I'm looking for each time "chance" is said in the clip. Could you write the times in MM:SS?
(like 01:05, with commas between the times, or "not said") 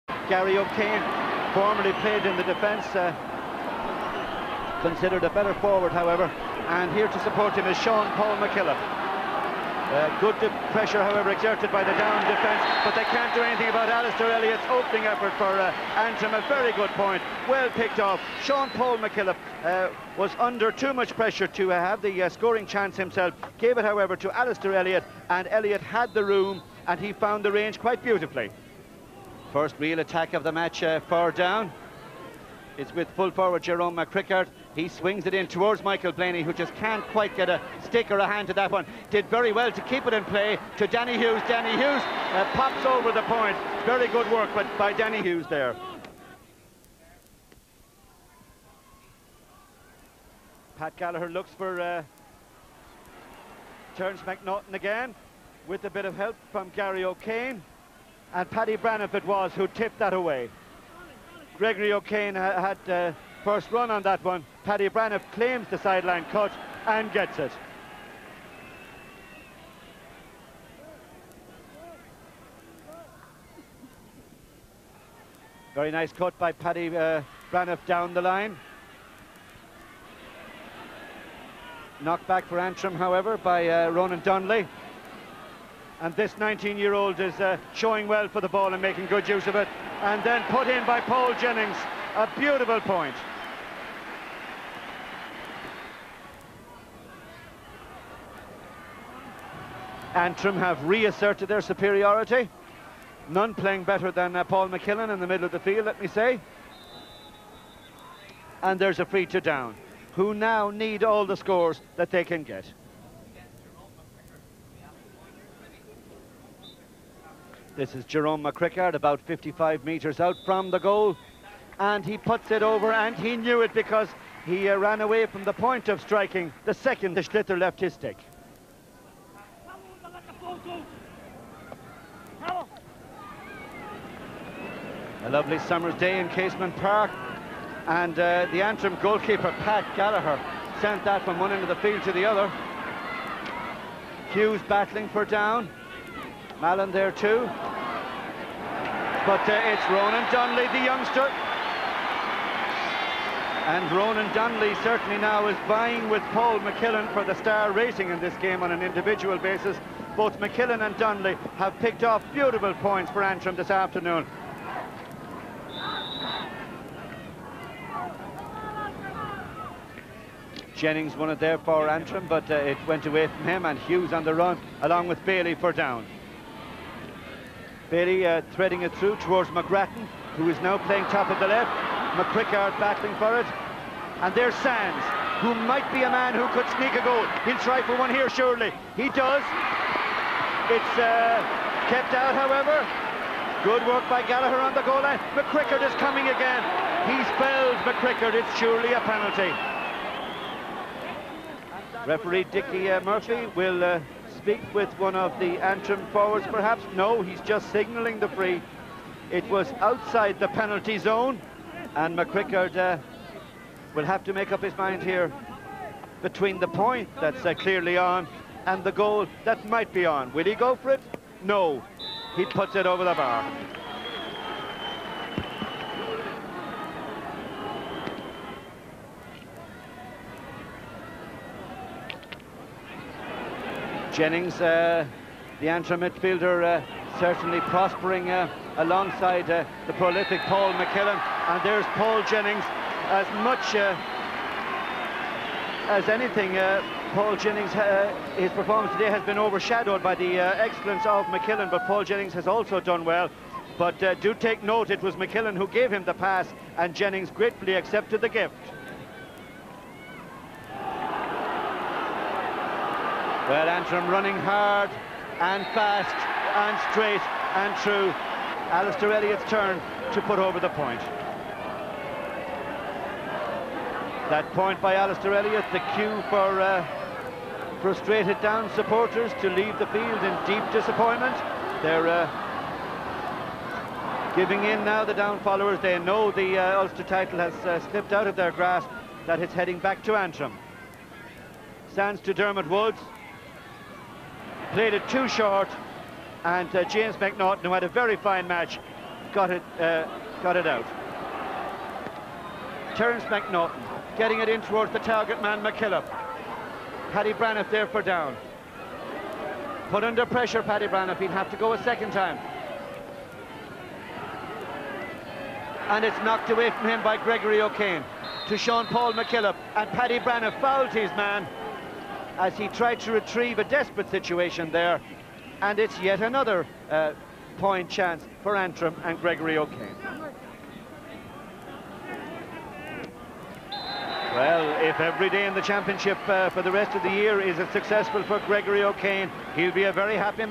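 00:22, 05:27.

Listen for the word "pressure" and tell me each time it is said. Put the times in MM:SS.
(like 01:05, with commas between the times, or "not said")
00:10, 00:21, 05:10.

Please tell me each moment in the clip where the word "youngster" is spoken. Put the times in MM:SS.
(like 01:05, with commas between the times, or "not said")
02:30.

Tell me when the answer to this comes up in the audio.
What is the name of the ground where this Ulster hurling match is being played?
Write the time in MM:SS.
02:16.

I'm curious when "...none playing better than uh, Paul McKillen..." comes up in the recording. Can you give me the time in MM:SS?
01:43.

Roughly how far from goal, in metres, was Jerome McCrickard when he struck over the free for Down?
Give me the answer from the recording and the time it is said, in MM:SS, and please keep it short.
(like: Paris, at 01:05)
55, at 01:59.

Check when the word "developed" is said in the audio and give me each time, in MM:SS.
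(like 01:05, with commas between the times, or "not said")
not said.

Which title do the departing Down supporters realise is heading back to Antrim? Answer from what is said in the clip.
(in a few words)
Ulster title.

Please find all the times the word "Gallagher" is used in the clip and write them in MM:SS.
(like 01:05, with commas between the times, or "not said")
00:50, 02:19, 03:14.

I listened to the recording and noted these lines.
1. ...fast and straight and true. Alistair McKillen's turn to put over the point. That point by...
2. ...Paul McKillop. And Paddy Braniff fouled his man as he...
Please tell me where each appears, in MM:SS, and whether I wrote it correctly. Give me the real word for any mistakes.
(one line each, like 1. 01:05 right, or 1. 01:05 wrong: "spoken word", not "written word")
1. 04:25 wrong: "Elliott", not "McKillen"
2. 05:18 right.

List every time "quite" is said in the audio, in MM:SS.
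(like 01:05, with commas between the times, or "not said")
00:27, 00:37.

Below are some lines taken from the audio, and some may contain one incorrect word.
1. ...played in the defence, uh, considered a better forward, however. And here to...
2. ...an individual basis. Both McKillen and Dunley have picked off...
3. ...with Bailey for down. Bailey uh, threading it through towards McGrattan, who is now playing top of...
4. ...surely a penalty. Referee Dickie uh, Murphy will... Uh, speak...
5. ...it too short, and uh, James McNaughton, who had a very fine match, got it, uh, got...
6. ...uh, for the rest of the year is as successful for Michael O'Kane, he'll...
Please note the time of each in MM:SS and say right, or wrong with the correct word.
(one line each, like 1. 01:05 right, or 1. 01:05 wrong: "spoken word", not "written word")
1. 00:01 right
2. 02:38 right
3. 02:55 right
4. 03:18 right
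5. 04:54 right
6. 05:36 wrong: "Gregory", not "Michael".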